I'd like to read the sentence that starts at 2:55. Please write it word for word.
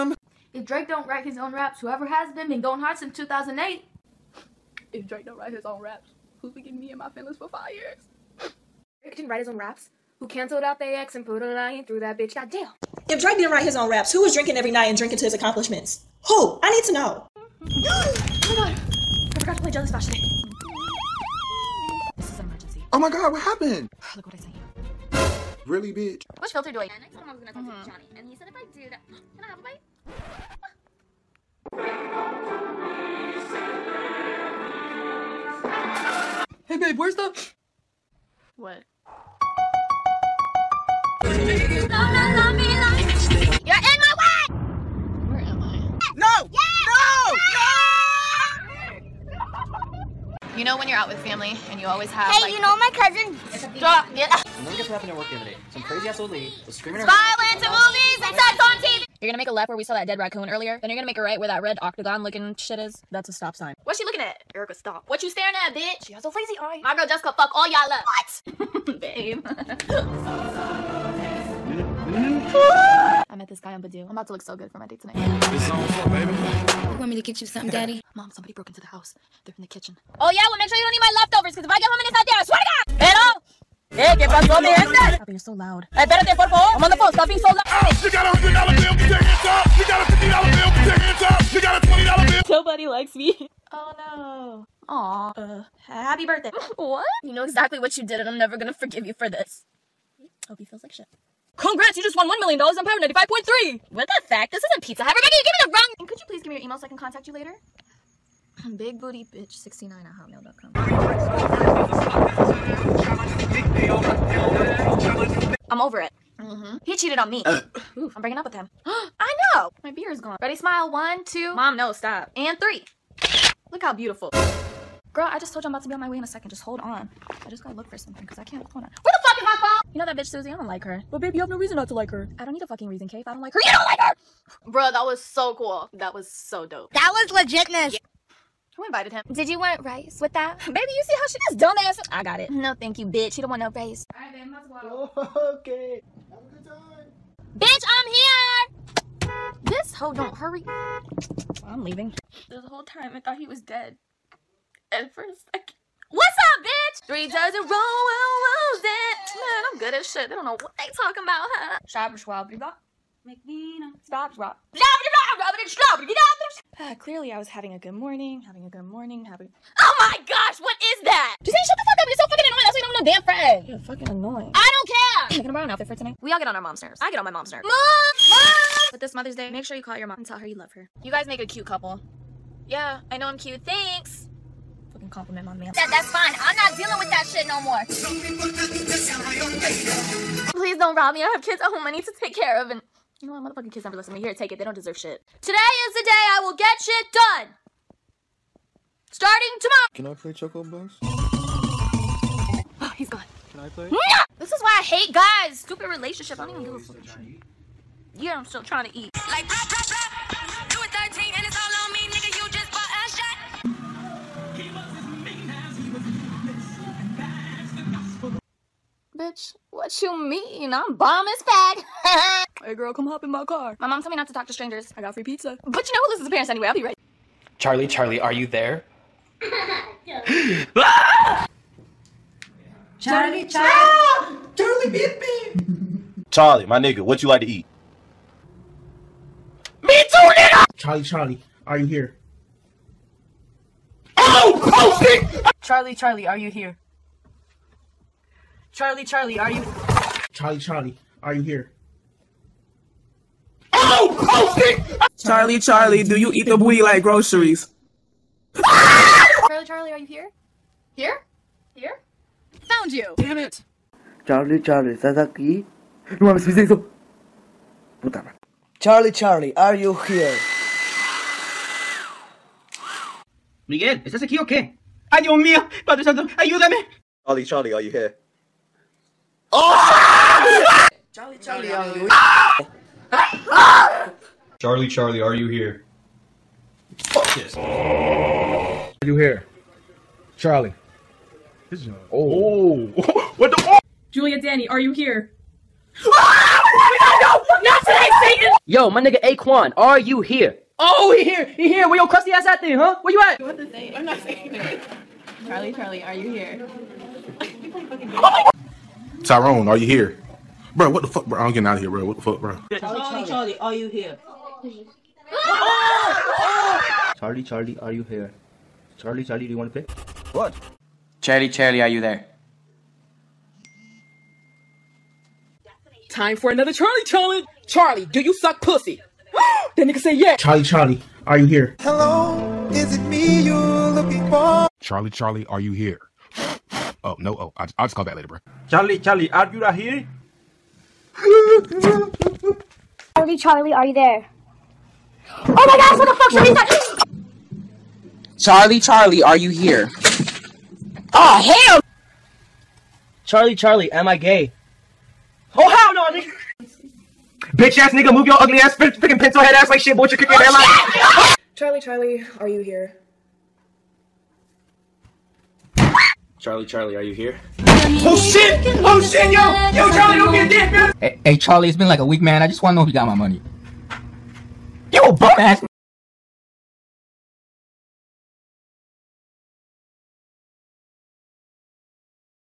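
Can I borrow an outfit for tonight?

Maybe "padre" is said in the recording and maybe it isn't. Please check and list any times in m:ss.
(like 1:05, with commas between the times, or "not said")
4:35.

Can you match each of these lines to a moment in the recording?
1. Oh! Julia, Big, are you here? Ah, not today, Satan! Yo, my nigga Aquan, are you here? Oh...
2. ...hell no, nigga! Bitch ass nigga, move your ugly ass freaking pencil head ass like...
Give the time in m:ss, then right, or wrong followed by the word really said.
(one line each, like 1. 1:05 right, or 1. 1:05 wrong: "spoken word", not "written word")
1. 4:53 wrong: "Danny", not "Big"
2. 5:55 right.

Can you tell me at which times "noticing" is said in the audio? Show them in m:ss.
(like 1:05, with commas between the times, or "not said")
not said.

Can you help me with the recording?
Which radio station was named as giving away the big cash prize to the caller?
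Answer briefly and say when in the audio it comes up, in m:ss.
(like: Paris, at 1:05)
Power 95.3, at 1:42.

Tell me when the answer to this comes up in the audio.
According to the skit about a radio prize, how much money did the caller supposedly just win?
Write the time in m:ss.
1:42.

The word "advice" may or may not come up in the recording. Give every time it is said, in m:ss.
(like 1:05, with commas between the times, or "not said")
not said.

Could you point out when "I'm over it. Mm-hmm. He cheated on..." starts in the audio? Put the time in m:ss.
1:55.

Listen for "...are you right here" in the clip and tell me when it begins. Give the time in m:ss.
5:39.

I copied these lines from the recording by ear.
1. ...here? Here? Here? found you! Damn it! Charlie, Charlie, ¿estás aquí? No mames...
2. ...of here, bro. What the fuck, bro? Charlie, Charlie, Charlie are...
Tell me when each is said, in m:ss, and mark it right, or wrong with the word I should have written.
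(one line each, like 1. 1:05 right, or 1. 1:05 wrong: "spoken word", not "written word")
1. 4:20 right
2. 5:11 right.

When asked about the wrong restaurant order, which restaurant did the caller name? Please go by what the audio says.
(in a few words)
Pizza Hut.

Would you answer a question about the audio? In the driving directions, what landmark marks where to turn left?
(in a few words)
dead raccoon.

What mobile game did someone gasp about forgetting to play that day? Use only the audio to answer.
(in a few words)
Jelly Splash.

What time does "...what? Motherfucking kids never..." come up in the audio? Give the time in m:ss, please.
3:13.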